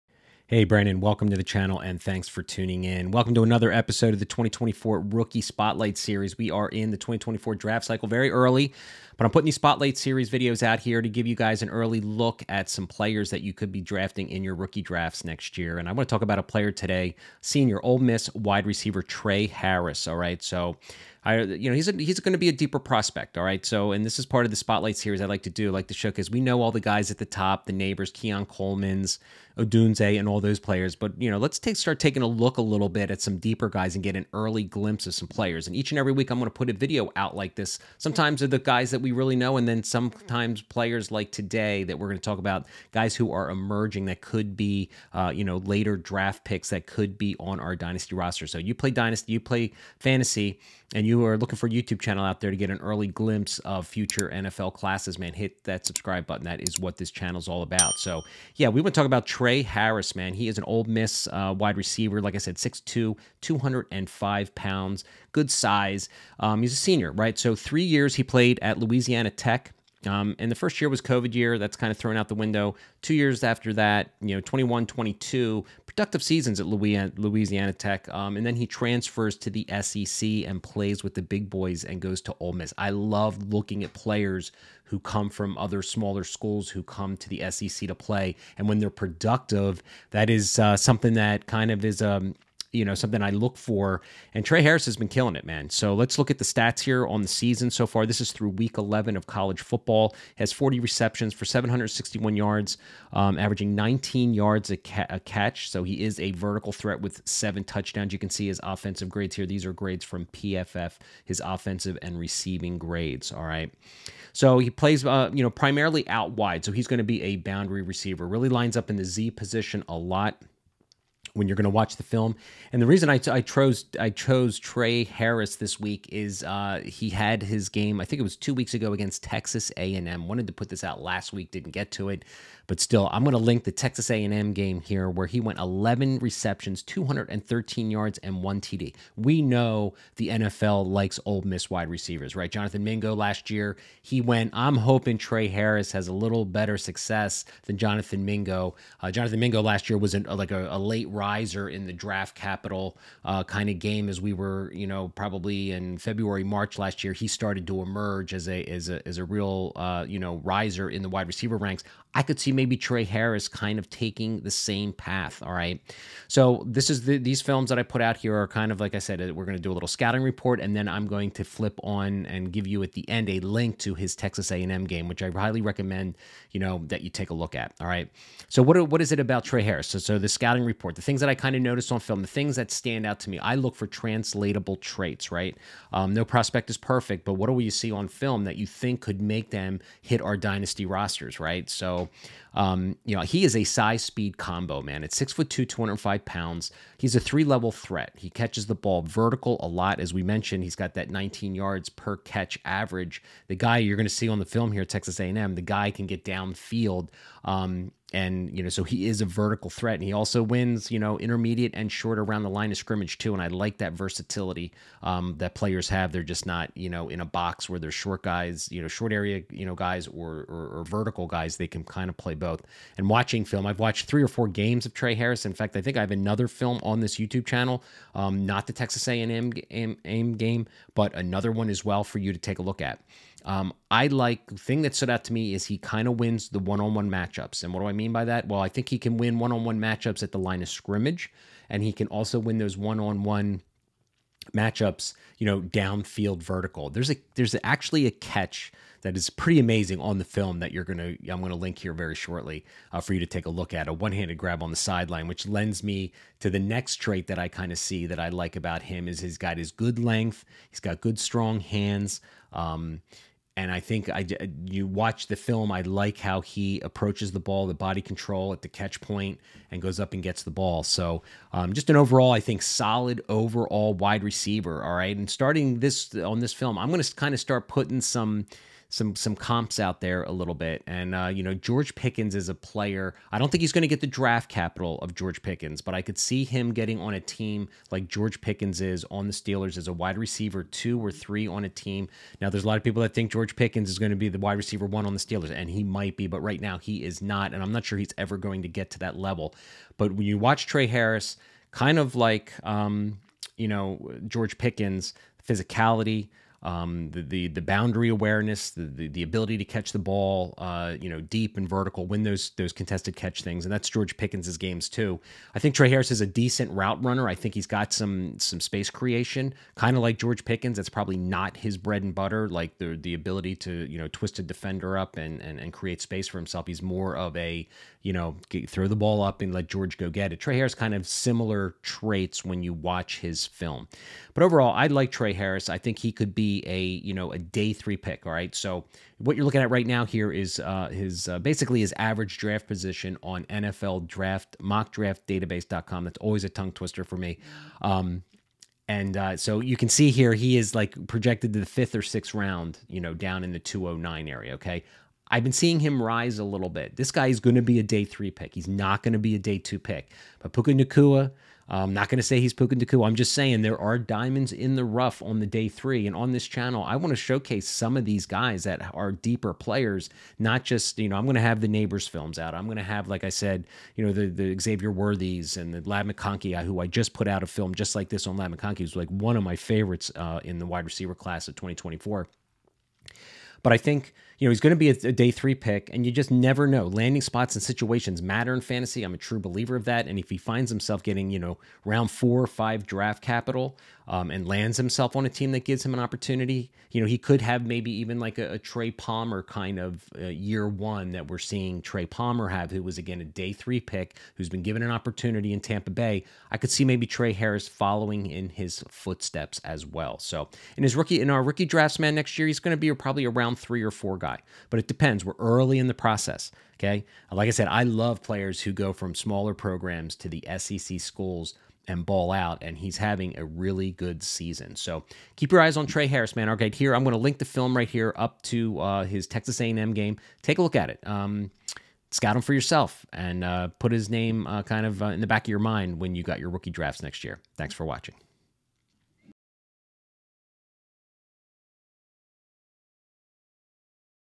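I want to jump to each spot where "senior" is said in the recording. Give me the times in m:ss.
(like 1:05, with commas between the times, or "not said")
0:17, 1:06.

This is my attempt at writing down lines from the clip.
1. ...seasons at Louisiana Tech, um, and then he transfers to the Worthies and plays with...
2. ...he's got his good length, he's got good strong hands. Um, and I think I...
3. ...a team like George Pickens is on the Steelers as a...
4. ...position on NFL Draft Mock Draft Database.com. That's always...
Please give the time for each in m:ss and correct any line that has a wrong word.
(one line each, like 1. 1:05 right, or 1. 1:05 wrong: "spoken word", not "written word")
1. 1:16 wrong: "SEC", not "Worthies"
2. 4:19 right
3. 4:47 right
4. 5:42 right.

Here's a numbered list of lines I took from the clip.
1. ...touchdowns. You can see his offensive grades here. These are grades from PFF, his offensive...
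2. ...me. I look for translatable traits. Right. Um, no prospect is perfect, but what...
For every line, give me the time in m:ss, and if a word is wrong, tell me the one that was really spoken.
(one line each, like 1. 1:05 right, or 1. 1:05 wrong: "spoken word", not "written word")
1. 1:47 right
2. 3:03 right.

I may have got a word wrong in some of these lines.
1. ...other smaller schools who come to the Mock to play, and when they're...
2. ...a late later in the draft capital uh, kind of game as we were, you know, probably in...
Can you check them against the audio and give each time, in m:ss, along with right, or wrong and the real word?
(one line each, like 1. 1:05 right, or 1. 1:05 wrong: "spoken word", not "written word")
1. 1:25 wrong: "SEC", not "Mock"
2. 2:30 wrong: "riser", not "later".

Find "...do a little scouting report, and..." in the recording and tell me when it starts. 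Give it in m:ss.
2:49.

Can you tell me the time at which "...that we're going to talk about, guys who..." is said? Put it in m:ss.
0:41.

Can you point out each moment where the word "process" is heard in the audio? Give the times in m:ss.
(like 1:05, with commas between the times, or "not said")
6:55.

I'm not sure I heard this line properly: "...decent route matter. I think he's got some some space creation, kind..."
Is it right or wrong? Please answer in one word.
wrong.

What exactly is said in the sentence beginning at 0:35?
And each and every week, I'm going to put a video out like this.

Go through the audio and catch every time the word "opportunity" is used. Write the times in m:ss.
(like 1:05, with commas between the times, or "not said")
6:35, 6:44.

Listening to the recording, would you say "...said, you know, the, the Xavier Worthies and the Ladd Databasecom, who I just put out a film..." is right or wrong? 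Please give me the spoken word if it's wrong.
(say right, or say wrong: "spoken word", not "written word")
wrong: "McConkey", not "Databasecom".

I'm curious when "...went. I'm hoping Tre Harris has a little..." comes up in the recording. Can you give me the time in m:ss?
2:24.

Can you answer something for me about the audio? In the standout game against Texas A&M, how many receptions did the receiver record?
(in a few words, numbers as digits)
11.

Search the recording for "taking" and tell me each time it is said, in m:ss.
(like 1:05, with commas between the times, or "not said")
0:31, 2:43.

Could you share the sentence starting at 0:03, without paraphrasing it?
Welcome to another episode of the 2024 Rookie Spotlight Series.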